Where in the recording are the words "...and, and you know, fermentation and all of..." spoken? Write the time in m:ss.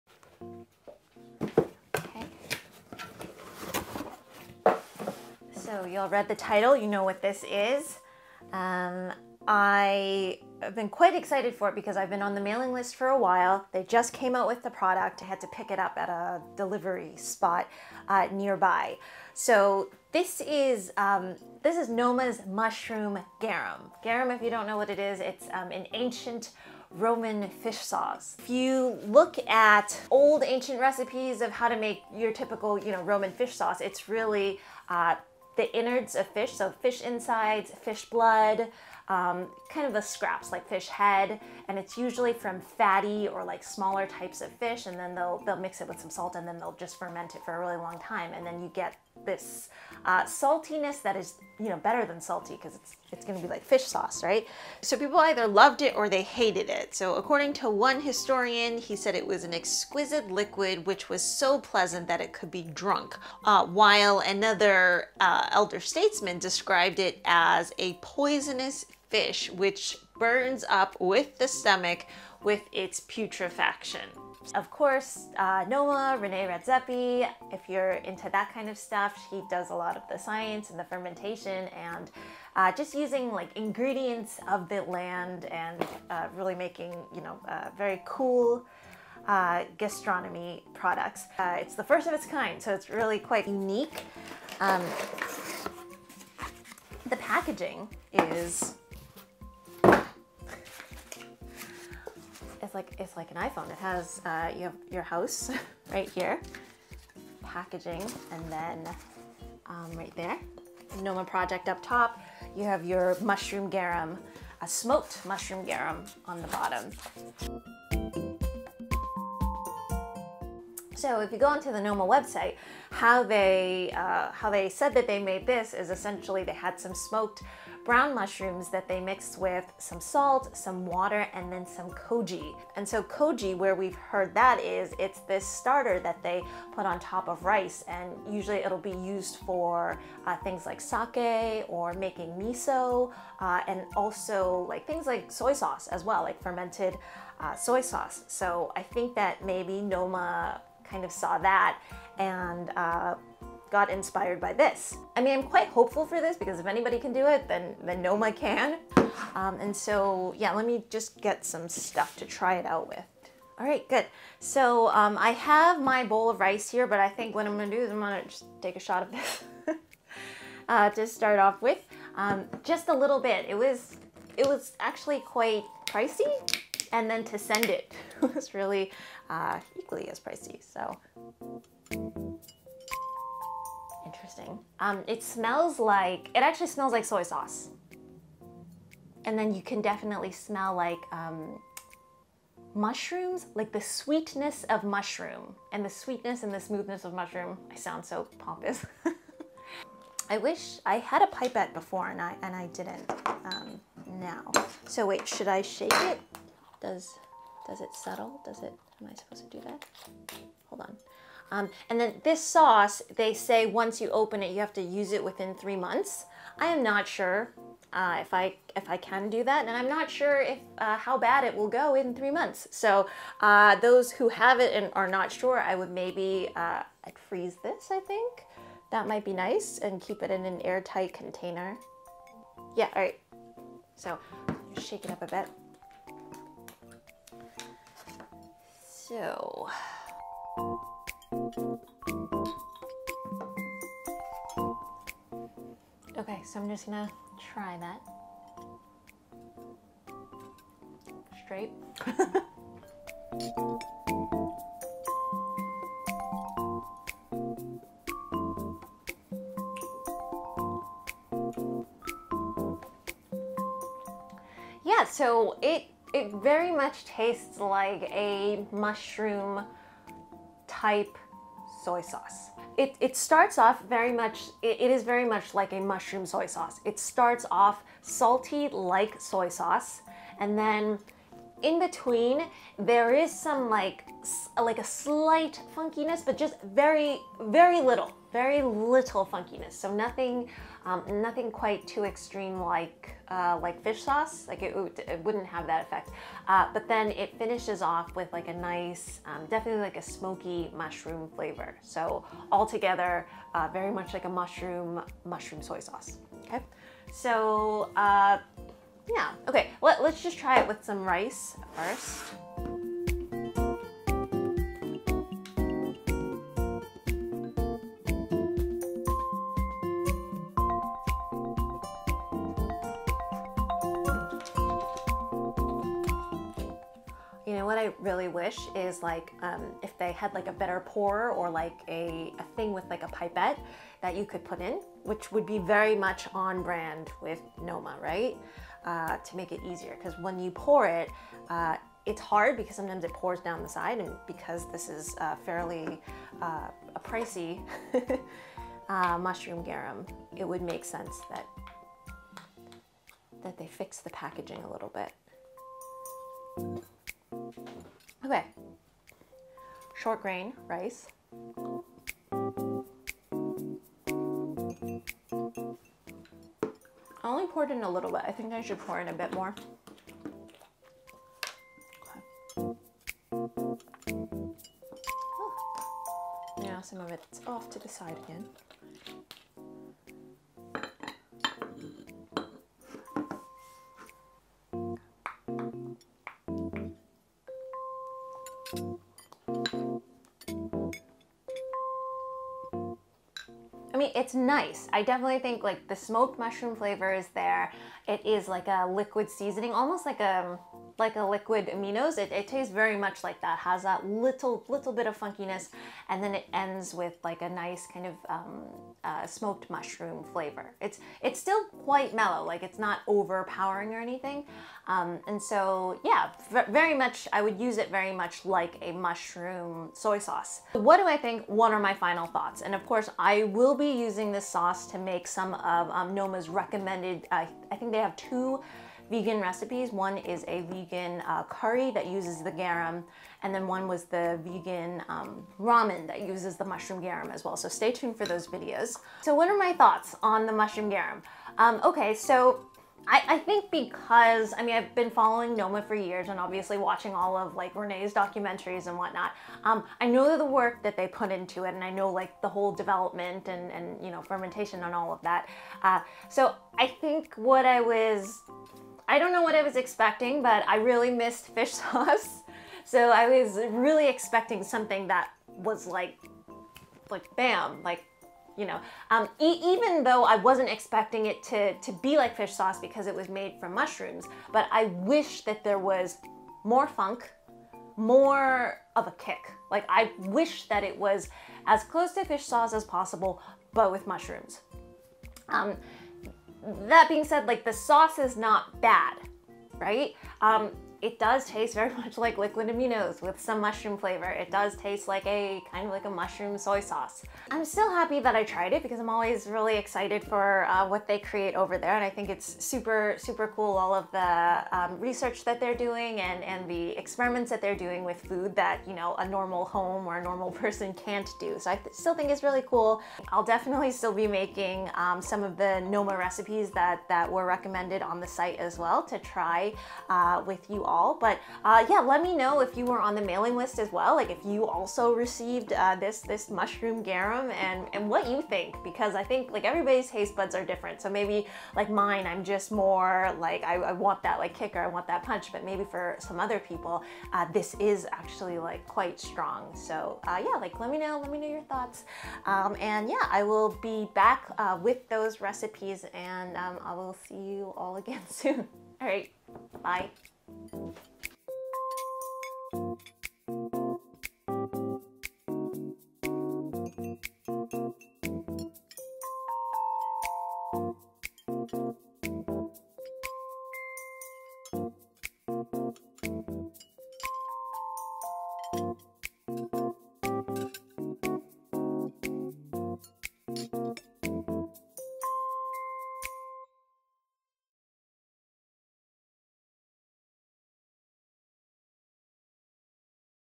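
7:33.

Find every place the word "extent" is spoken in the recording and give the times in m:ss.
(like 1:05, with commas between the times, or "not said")
not said.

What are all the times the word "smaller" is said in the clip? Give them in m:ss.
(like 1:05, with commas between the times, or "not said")
0:43.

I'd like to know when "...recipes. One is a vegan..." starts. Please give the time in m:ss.
7:09.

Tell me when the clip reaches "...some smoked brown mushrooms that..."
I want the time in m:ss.
2:06.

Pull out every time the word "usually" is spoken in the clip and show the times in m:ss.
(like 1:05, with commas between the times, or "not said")
0:41, 2:18.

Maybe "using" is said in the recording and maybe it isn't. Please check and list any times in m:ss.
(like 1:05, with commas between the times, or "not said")
1:22, 7:04.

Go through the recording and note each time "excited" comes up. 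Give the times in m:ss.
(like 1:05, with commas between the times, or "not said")
0:11, 8:19.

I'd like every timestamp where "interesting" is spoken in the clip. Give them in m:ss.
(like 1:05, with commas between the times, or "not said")
3:04.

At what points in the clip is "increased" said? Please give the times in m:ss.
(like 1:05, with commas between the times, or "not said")
not said.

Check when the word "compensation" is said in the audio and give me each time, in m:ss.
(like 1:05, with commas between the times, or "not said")
not said.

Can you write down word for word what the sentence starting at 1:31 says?
Uh, it's the first of its kind, so it's really quite unique.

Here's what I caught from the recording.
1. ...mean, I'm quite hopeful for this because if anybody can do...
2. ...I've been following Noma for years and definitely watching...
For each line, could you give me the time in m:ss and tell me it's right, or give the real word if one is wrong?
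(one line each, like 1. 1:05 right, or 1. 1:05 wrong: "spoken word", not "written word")
1. 2:35 right
2. 7:24 wrong: "obviously", not "definitely".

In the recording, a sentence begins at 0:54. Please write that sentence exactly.
So people either loved it or they hated it.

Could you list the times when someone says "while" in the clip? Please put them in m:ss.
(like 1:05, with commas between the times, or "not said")
0:13, 1:03.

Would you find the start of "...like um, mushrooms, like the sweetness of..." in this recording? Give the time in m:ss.
3:10.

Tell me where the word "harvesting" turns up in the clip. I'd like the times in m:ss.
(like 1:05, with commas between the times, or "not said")
not said.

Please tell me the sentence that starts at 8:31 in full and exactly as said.
So I th still think it's really cool.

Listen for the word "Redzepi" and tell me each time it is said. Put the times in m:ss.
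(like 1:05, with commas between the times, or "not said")
1:16.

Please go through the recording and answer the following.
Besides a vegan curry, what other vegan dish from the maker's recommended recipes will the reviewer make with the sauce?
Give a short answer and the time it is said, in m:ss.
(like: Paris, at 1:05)
ramen, at 7:15.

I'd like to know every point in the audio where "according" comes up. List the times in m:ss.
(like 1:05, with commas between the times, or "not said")
0:57.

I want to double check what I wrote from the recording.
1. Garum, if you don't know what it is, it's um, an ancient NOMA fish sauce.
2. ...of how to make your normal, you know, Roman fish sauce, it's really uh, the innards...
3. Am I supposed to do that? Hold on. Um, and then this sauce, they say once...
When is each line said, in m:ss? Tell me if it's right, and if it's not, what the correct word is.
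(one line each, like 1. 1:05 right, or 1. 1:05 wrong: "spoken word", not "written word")
1. 0:24 wrong: "Roman", not "NOMA"
2. 0:31 wrong: "typical", not "normal"
3. 3:29 right.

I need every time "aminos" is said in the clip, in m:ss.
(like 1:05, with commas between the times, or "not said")
6:41, 8:12.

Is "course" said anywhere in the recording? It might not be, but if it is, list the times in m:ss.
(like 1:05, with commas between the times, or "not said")
1:14, 7:02.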